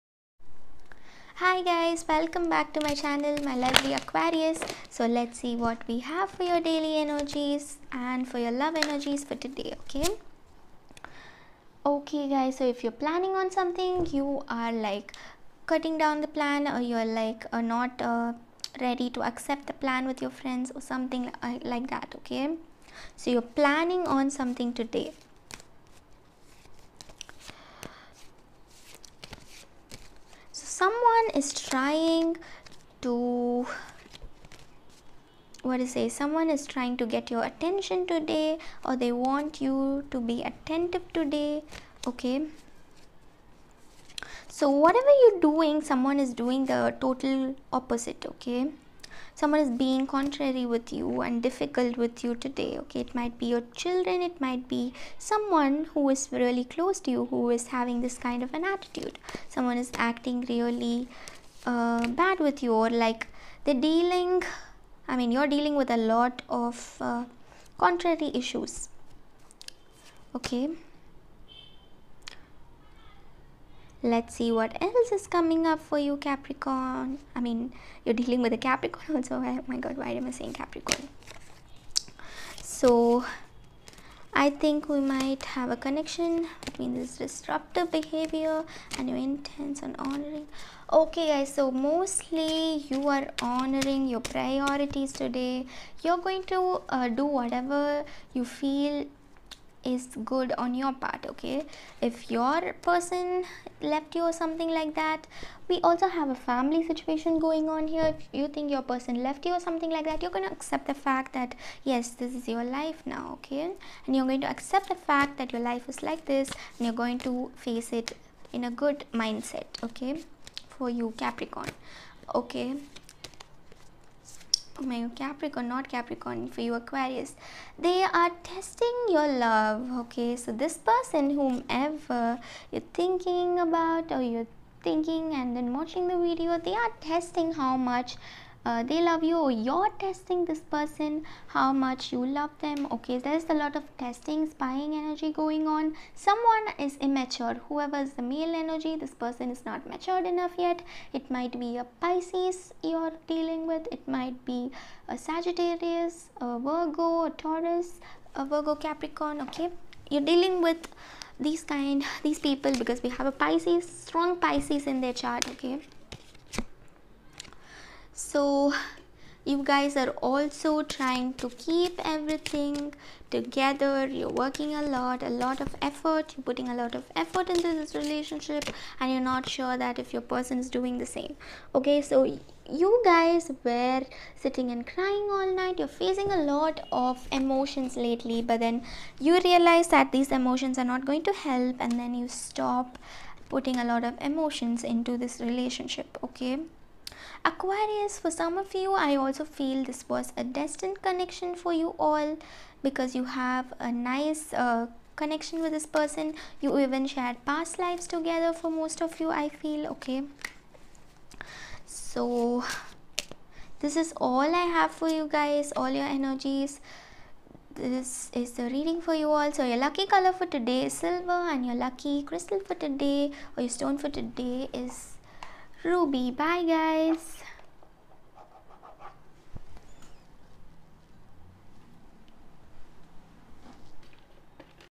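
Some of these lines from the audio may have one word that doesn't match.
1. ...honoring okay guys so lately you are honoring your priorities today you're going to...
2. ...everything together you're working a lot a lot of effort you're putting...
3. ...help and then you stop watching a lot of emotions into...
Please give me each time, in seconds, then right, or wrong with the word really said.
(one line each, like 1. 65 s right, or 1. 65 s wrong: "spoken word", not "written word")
1. 89 s wrong: "mostly", not "lately"
2. 172 s right
3. 191 s wrong: "putting", not "watching".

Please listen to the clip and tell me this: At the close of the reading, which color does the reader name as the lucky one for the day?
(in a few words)
Silver.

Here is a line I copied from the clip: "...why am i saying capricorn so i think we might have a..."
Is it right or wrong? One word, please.
right.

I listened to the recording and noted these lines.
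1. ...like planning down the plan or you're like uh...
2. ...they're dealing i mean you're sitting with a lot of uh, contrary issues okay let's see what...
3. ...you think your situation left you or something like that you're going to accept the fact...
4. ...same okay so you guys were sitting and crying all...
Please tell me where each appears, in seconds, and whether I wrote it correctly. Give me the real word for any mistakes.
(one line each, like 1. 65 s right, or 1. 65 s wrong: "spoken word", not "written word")
1. 14 s wrong: "cutting", not "planning"
2. 63 s wrong: "dealing", not "sitting"
3. 108 s wrong: "person", not "situation"
4. 181 s right.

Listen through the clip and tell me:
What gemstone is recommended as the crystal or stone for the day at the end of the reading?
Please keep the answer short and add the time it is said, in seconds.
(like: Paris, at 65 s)
Ruby, at 225 s.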